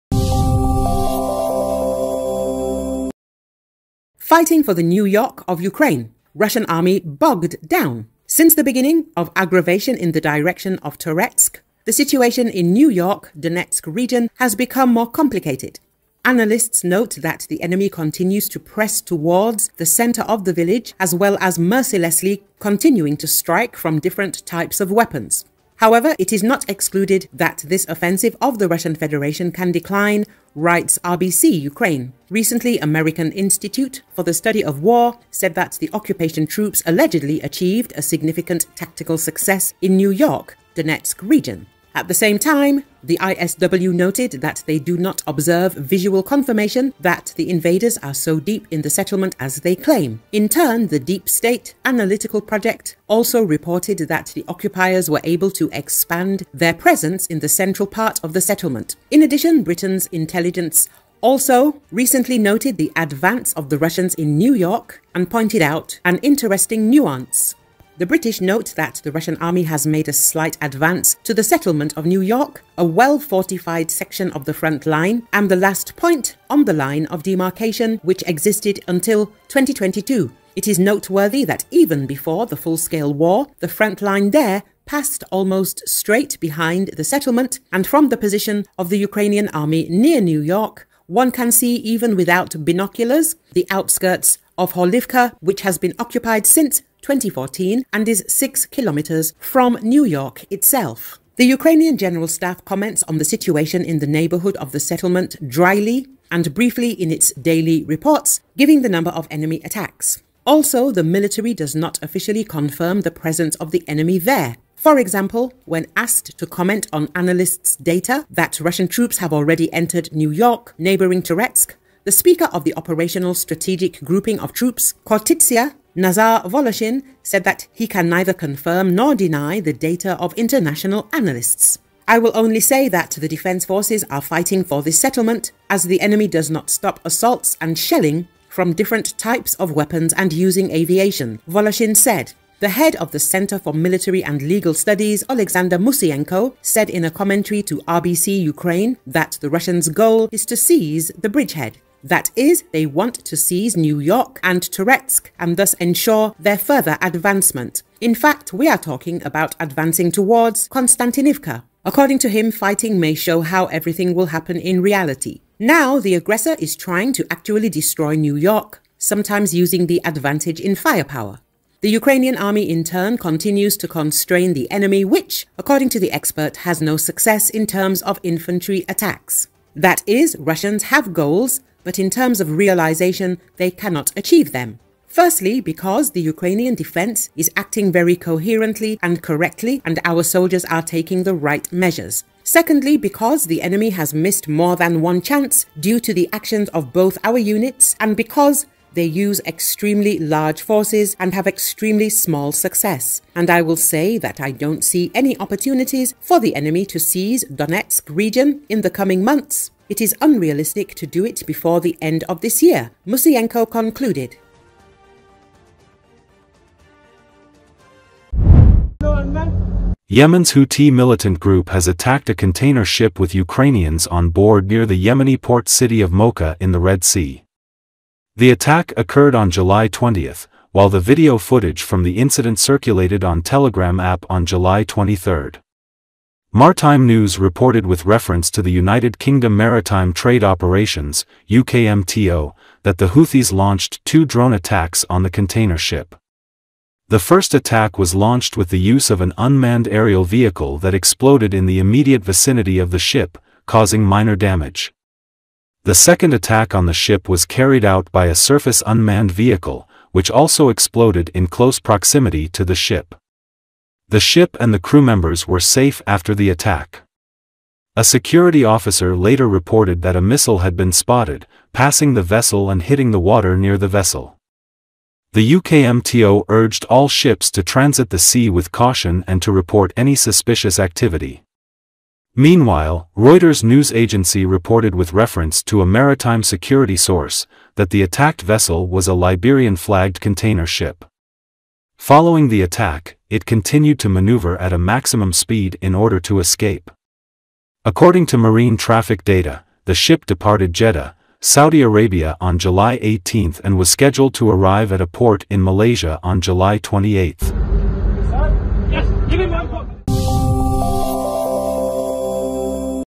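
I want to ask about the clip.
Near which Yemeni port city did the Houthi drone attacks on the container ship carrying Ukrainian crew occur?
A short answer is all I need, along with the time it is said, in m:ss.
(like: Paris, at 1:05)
Mocha, at 3:46.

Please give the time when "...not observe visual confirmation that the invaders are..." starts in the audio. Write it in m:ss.
0:44.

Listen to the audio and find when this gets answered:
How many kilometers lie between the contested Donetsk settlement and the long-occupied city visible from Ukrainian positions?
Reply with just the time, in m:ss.
1:38.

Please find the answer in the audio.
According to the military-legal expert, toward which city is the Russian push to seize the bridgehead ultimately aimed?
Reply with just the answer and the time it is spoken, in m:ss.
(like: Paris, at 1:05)
Konstantinivka, at 2:40.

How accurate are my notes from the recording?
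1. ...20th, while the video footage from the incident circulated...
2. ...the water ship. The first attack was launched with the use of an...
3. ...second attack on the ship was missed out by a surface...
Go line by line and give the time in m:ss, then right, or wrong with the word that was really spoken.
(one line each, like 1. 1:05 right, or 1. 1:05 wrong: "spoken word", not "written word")
1. 3:49 right
2. 4:05 wrong: "container", not "water"
3. 4:15 wrong: "carried", not "missed".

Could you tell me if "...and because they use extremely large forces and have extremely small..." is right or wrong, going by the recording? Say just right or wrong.
right.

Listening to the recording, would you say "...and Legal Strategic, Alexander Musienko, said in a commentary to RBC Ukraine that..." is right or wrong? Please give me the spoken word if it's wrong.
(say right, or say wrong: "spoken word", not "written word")
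wrong: "Studies", not "Strategic".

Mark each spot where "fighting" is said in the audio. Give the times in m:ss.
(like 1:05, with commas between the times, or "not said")
0:04, 2:14, 2:42.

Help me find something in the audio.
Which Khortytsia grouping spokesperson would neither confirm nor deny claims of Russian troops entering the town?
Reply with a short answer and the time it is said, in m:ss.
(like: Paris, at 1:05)
Nazar Voloshin, at 2:05.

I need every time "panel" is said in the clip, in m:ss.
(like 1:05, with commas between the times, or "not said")
not said.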